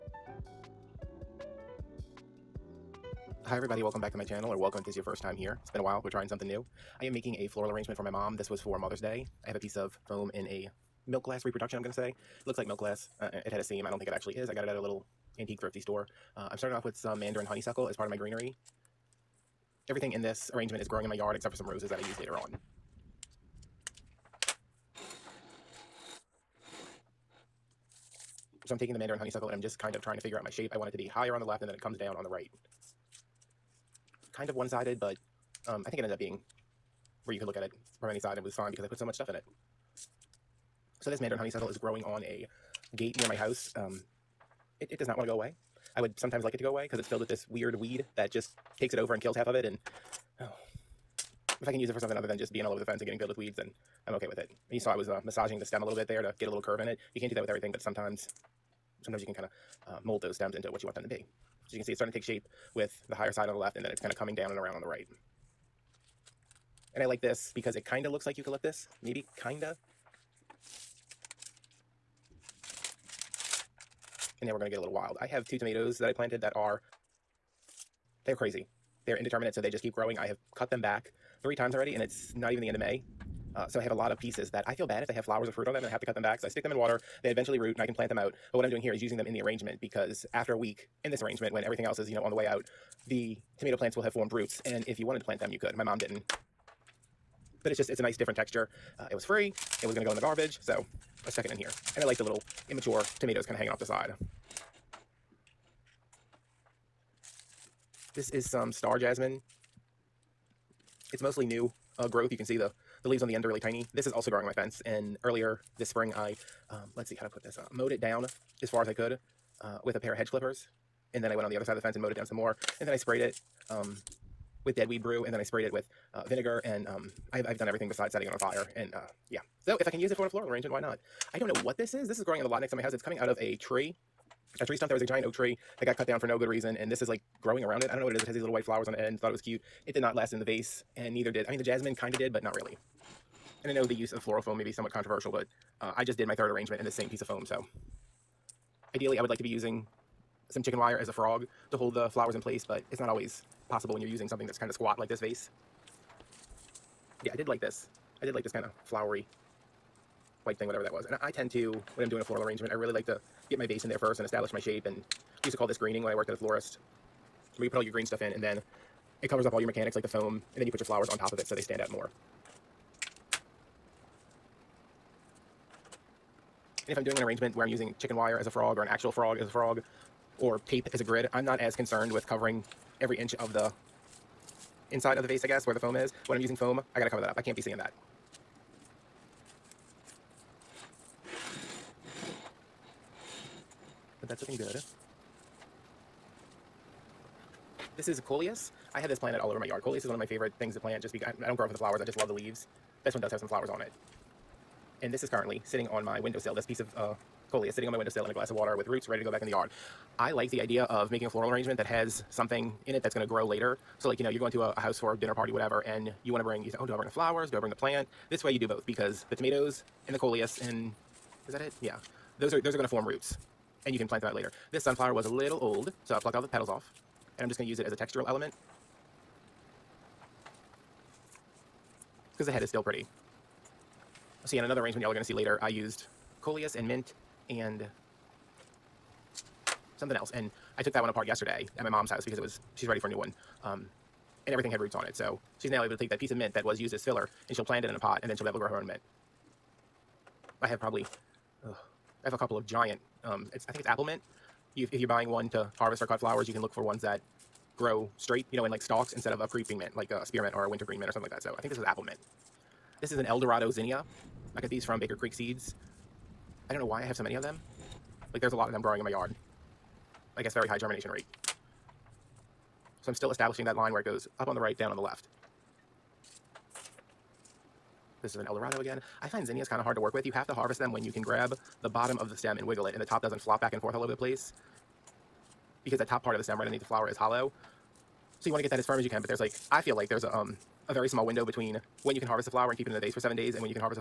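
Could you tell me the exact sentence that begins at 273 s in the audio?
So I'm still establishing that line where it goes up on the right, down on the left.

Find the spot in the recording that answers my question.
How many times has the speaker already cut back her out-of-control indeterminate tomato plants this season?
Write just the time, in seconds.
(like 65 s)
81 s.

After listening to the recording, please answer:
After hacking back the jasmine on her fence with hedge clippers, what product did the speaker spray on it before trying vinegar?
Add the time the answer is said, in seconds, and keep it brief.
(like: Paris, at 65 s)
Deadweed Brew, at 124 s.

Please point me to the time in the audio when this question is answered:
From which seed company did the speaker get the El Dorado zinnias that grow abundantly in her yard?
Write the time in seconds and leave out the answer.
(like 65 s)
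264 s.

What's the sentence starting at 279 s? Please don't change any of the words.
I find zinnias kind of hard to work with.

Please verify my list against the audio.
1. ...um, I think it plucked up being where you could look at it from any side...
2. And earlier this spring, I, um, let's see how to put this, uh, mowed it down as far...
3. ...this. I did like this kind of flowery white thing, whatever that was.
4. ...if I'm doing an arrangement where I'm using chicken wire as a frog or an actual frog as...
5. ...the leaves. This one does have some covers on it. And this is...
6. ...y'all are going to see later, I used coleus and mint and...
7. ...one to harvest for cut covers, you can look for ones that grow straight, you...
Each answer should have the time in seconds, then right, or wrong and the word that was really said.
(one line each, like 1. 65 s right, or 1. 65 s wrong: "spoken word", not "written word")
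1. 35 s wrong: "ended", not "plucked"
2. 114 s right
3. 157 s right
4. 176 s right
5. 202 s wrong: "flowers", not "covers"
6. 235 s right
7. 255 s wrong: "flowers", not "covers".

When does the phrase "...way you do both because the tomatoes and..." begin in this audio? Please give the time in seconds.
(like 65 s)
218 s.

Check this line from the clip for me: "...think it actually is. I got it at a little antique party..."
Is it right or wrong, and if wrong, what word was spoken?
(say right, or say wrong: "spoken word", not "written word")
wrong: "thrifty", not "party".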